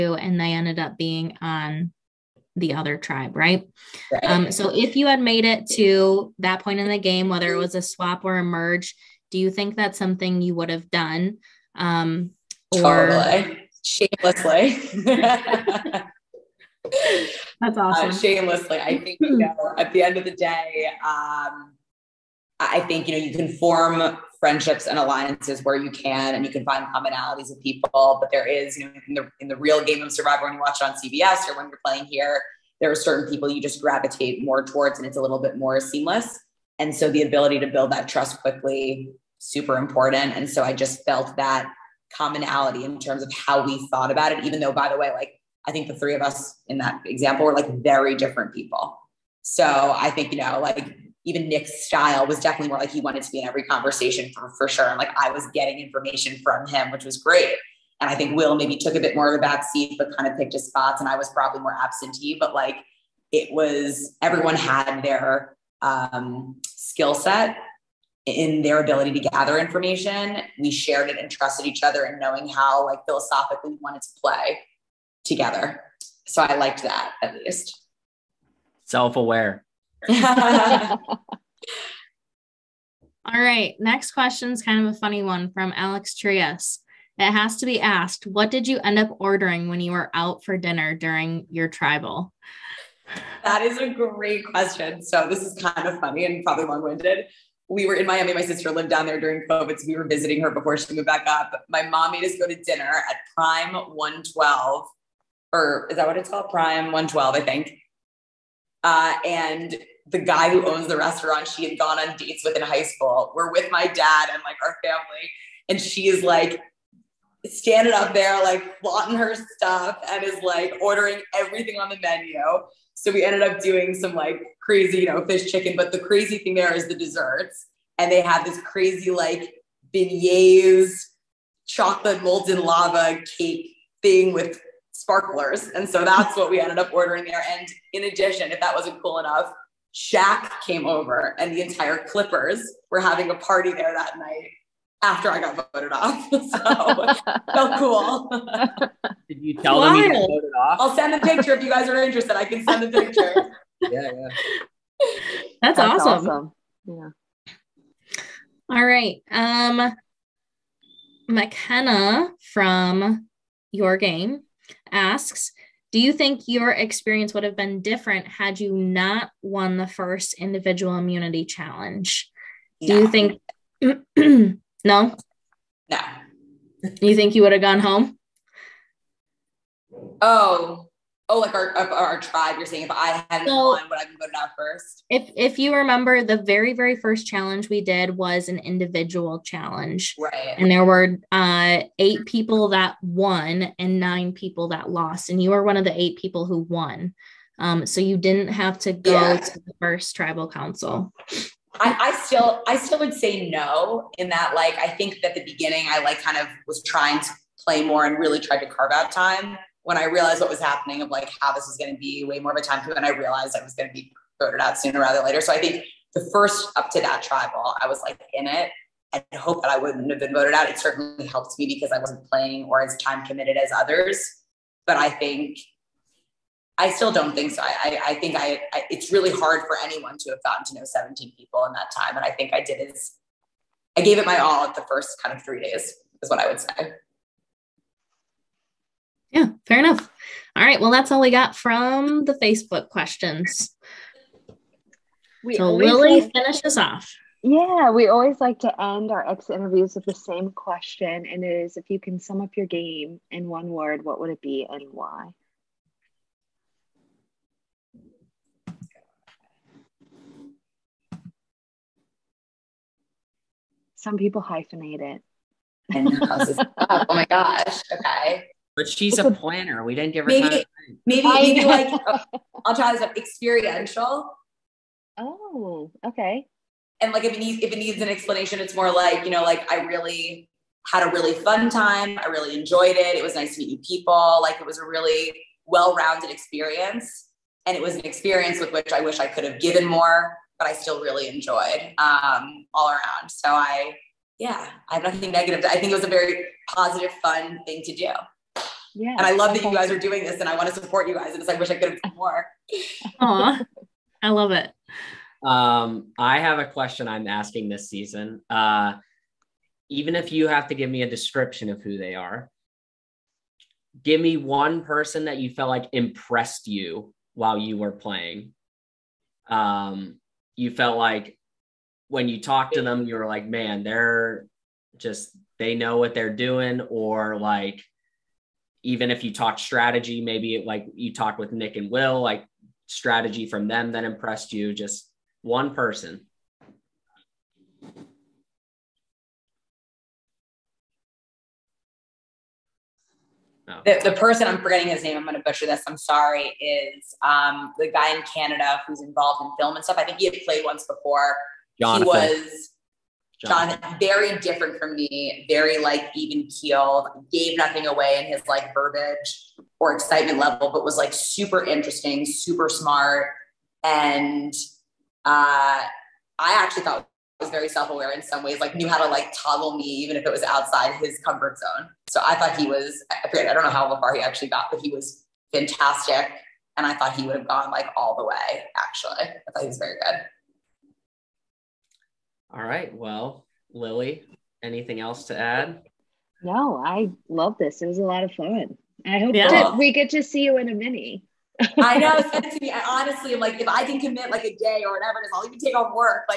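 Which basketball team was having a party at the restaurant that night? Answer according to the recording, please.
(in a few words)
Clippers.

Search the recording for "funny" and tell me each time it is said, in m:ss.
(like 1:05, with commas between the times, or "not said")
1:24, 1:35.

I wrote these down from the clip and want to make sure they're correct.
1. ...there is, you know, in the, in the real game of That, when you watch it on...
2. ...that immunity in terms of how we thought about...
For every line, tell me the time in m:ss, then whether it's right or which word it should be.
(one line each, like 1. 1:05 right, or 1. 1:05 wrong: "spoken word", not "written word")
1. 0:28 wrong: "Survivor", not "That"
2. 0:41 wrong: "commonality", not "immunity".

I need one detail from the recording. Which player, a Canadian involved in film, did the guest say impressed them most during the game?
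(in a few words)
Jonathan.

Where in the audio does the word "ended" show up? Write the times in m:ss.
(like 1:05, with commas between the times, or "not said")
0:00, 2:03, 2:16.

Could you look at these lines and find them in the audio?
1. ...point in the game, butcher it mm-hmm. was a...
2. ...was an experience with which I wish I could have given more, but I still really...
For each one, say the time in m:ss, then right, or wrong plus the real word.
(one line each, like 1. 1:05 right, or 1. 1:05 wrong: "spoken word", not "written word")
1. 0:06 wrong: "whether", not "butcher"
2. 4:47 right.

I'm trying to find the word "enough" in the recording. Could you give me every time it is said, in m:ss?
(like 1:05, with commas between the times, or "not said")
2:19, 3:59.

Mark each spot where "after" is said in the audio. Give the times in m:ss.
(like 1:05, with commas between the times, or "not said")
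2:25.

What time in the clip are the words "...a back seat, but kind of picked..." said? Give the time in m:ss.
0:59.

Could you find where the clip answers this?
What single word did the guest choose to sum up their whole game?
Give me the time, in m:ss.
4:33.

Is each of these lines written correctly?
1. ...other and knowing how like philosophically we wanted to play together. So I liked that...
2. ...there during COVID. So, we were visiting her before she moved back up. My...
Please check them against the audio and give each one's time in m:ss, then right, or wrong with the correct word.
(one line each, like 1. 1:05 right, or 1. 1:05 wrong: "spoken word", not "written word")
1. 1:11 right
2. 1:39 right.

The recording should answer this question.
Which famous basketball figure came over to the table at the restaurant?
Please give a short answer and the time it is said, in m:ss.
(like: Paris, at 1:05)
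Shaq, at 2:19.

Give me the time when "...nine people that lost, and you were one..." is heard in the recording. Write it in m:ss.
3:13.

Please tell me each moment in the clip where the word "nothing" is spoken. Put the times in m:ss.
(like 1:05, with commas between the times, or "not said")
4:55, 5:57.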